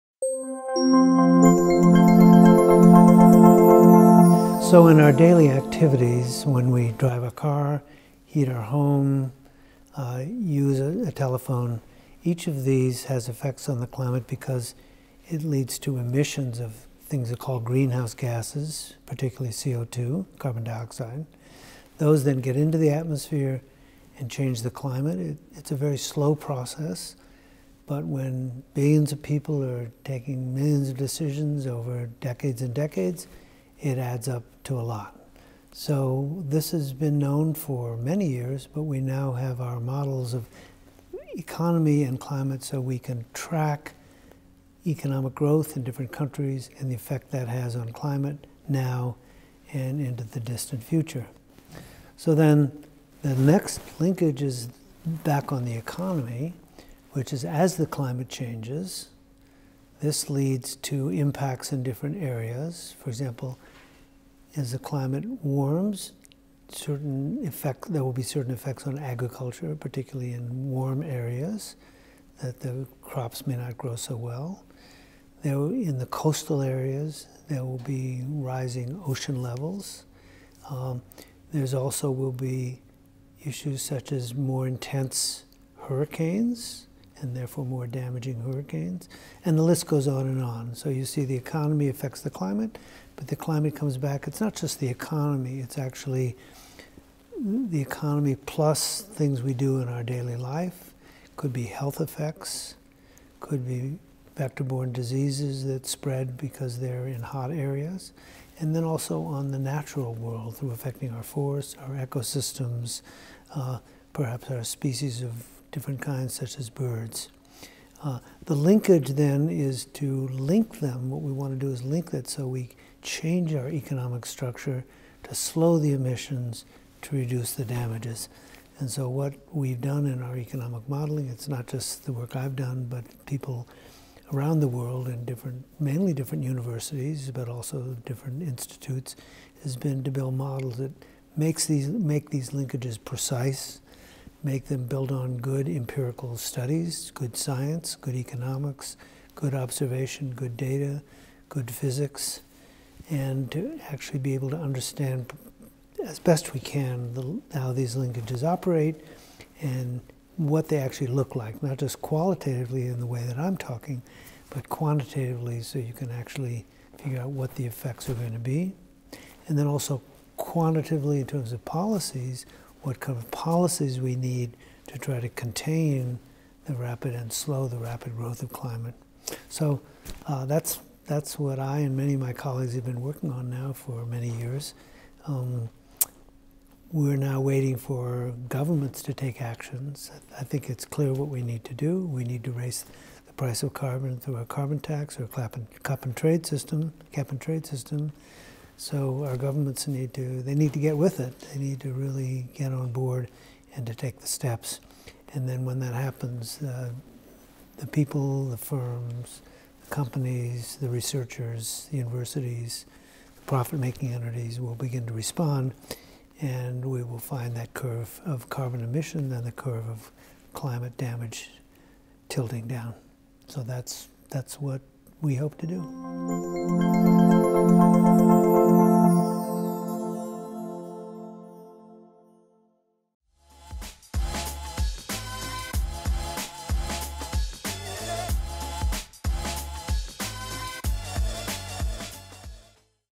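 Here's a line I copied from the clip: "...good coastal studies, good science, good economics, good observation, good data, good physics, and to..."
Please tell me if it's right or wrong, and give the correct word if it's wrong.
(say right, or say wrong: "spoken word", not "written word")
wrong: "empirical", not "coastal".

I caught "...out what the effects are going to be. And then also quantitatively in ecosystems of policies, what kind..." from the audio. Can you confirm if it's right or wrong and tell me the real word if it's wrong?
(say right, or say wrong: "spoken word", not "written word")
wrong: "terms", not "ecosystems".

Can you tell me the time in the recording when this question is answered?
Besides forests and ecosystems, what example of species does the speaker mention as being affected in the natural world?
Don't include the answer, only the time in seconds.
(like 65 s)
116 s.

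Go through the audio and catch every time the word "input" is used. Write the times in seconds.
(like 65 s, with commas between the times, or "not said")
not said.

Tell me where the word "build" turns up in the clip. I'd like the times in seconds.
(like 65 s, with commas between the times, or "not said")
140 s, 144 s.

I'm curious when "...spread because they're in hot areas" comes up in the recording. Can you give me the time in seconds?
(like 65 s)
105 s.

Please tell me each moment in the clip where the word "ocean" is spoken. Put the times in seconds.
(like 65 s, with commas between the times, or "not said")
79 s.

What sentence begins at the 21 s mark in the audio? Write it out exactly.
Those then get into the atmosphere and change the climate.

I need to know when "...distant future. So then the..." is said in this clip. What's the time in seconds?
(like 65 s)
50 s.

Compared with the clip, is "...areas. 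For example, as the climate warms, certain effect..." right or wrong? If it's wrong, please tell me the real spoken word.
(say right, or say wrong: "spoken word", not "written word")
right.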